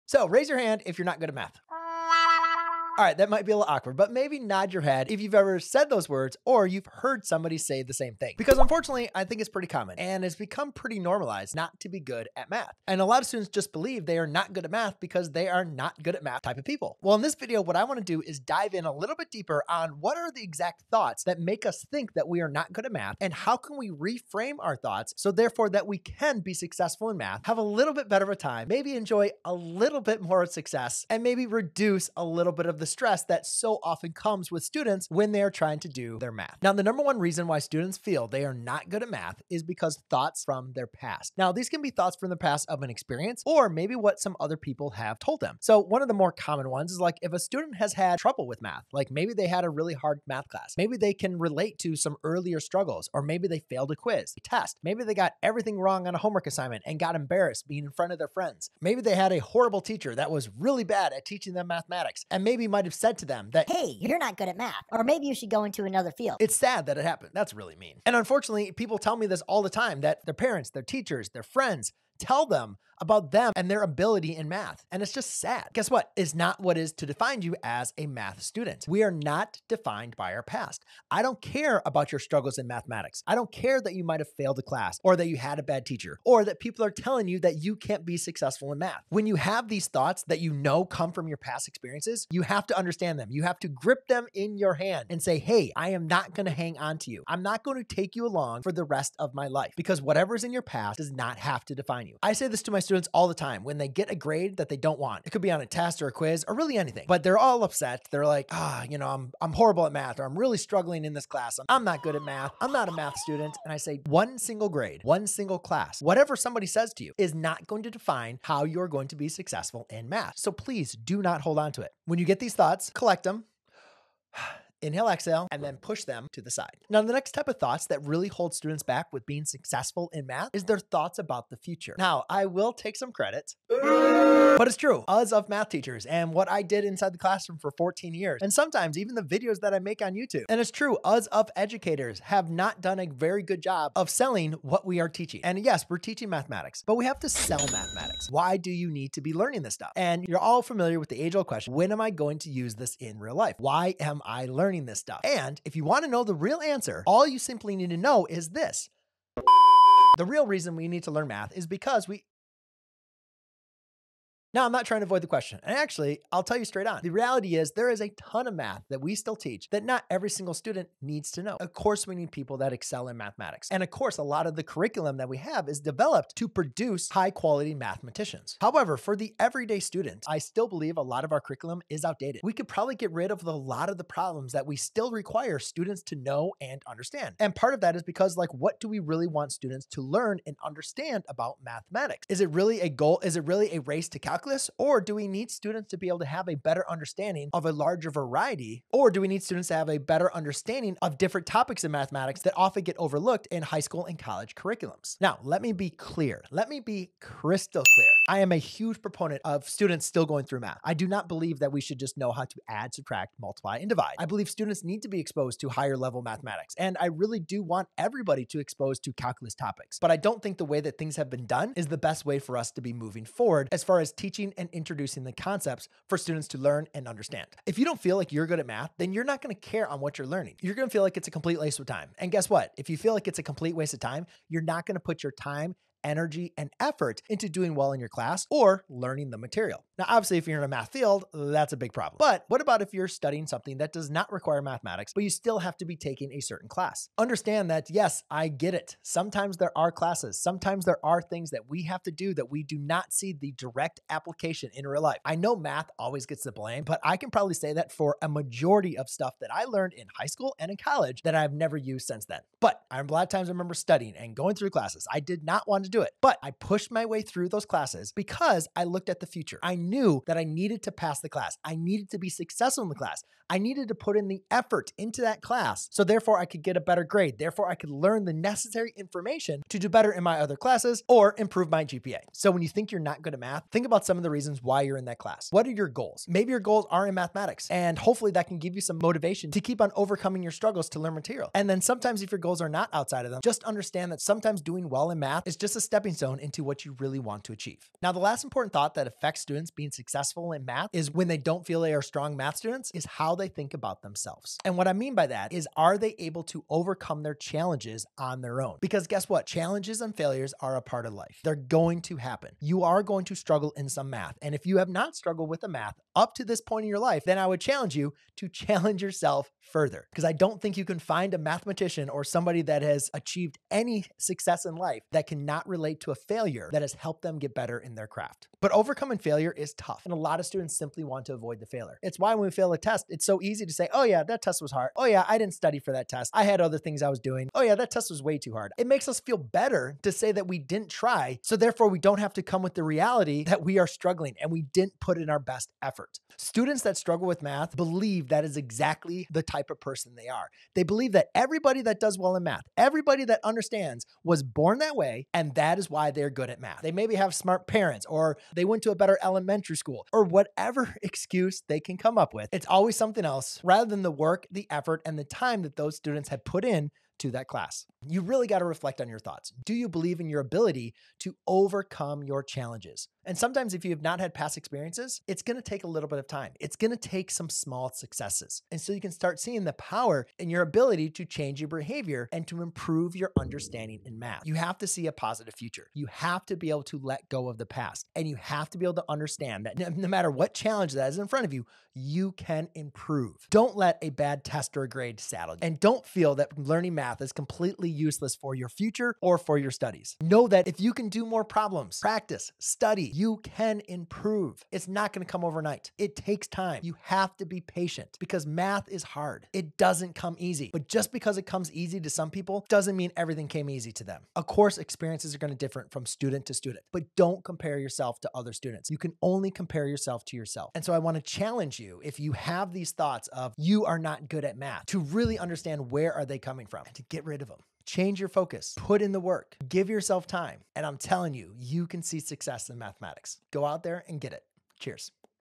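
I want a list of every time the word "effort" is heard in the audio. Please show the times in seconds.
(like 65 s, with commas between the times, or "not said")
236 s, 274 s, 345 s, 364 s.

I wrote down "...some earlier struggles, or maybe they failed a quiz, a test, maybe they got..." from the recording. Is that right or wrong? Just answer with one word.
right.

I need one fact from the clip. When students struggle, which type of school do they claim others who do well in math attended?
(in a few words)
A better elementary school.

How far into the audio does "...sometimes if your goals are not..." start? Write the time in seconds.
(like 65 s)
291 s.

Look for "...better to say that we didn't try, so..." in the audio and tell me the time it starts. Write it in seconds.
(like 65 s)
339 s.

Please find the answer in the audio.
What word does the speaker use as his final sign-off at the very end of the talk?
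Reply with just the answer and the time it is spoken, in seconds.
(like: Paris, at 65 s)
Cheers, at 434 s.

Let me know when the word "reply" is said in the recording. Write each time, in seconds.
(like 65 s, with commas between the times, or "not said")
not said.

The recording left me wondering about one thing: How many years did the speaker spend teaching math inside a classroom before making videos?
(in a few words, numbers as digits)
14.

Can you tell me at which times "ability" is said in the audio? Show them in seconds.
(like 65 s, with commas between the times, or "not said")
73 s, 370 s, 380 s.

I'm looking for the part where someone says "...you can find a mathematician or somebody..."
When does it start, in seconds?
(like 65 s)
320 s.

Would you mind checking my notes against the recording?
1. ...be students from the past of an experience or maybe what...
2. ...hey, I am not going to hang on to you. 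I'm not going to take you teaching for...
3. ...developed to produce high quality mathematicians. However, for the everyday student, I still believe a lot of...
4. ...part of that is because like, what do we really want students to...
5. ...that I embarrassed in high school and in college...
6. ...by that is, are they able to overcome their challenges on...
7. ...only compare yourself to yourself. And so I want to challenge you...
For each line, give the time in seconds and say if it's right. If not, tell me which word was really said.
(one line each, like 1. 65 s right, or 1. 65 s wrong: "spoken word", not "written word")
1. 41 s wrong: "thoughts", not "students"
2. 95 s wrong: "along", not "teaching"
3. 175 s right
4. 187 s right
5. 259 s wrong: "learned", not "embarrassed"
6. 305 s right
7. 419 s right.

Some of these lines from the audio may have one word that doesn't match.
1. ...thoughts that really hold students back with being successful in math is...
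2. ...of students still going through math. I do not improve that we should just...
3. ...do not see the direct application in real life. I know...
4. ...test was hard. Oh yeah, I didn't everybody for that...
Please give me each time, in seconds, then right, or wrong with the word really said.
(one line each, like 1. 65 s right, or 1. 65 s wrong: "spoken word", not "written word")
1. 127 s right
2. 209 s wrong: "believe", not "improve"
3. 252 s right
4. 334 s wrong: "study", not "everybody".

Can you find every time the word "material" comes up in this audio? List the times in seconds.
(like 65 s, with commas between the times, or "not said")
239 s, 291 s.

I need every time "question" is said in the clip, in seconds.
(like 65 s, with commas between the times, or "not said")
151 s, 165 s.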